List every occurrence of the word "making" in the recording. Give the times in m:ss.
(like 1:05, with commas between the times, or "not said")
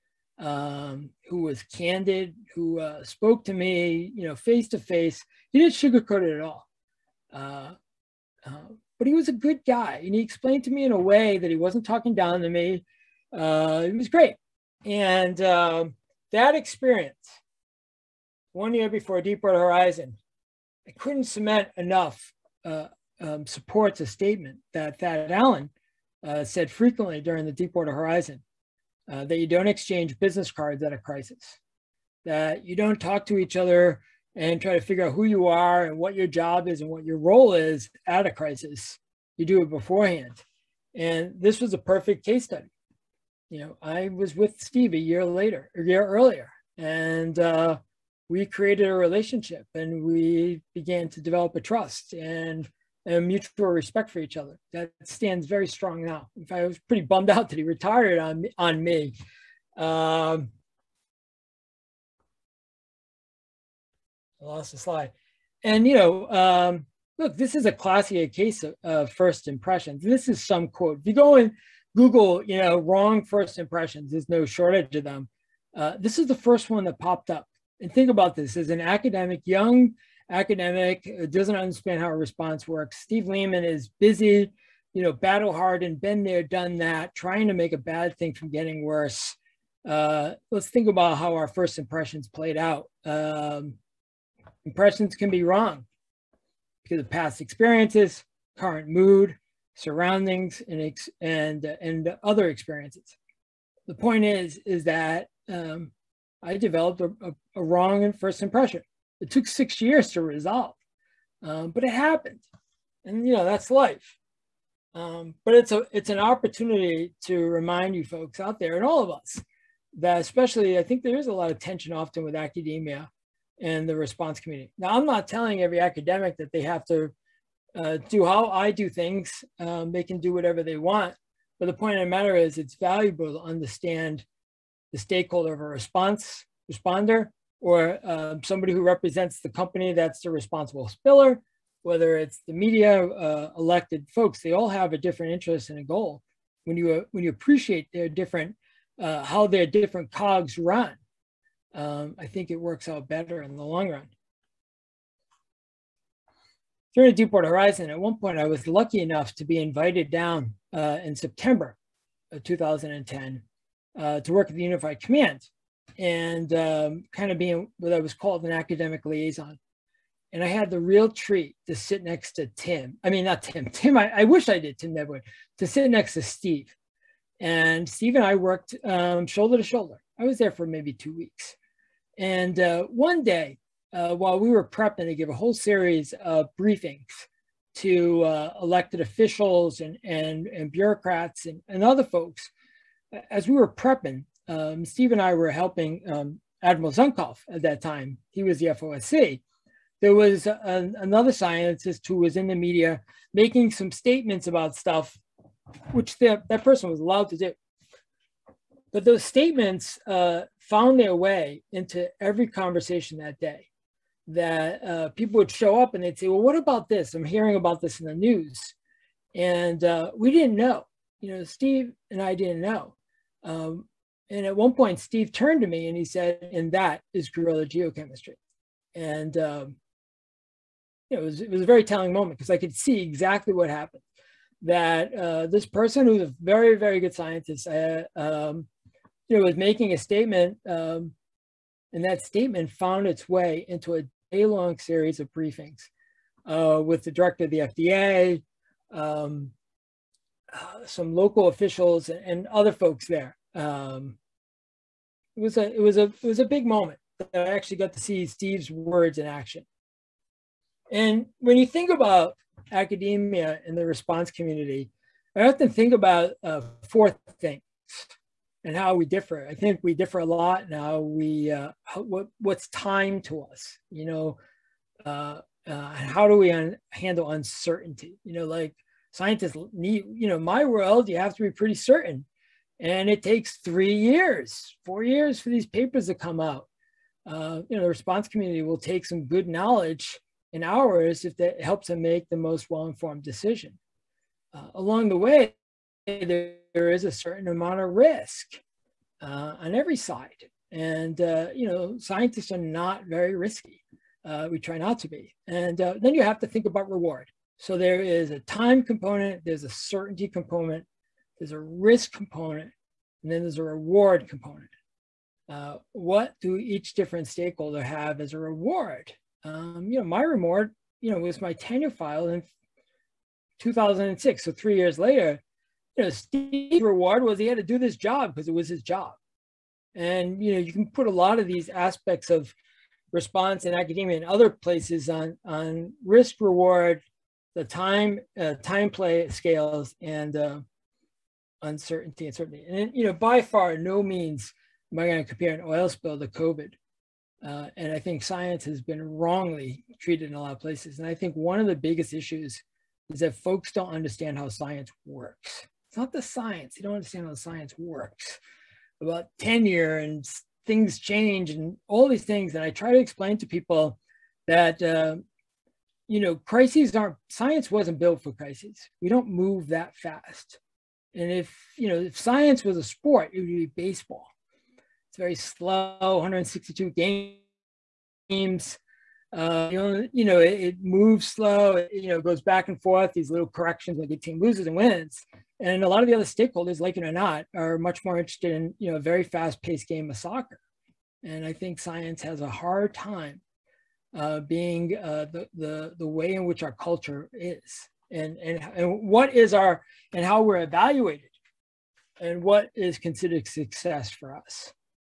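3:23, 3:59.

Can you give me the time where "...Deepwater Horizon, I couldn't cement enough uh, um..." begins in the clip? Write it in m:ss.
0:19.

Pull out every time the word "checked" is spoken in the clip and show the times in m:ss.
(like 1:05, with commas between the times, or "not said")
not said.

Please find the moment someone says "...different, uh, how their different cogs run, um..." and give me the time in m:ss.
2:28.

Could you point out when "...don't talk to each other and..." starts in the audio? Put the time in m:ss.
0:32.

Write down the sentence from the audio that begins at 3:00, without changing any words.
I was there for maybe two weeks.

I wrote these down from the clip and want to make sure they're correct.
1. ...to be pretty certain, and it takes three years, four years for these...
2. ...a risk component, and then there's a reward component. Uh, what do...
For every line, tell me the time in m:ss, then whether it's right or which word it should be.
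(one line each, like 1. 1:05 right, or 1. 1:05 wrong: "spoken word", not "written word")
1. 4:41 right
2. 5:11 right.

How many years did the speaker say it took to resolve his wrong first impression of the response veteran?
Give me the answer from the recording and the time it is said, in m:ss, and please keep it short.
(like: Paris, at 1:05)
6, at 1:49.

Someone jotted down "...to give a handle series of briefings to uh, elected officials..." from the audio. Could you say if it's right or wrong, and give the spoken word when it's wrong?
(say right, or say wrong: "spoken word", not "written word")
wrong: "whole", not "handle".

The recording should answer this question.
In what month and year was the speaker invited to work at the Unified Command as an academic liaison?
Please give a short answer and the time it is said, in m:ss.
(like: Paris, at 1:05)
September 2010, at 2:41.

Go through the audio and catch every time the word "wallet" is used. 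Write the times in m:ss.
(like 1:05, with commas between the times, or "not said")
not said.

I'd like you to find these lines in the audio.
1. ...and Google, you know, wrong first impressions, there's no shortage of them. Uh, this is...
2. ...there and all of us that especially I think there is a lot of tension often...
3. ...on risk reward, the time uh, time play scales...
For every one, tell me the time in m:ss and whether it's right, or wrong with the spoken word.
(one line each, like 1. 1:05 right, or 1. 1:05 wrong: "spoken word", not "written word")
1. 1:11 right
2. 1:58 right
3. 5:35 right.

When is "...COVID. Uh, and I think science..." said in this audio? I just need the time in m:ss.
5:46.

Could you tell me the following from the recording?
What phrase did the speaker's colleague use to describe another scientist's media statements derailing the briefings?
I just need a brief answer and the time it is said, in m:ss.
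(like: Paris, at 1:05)
guerrilla geochemistry, at 3:47.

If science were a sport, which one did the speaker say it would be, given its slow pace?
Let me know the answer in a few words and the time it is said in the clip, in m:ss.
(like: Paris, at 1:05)
baseball, at 6:13.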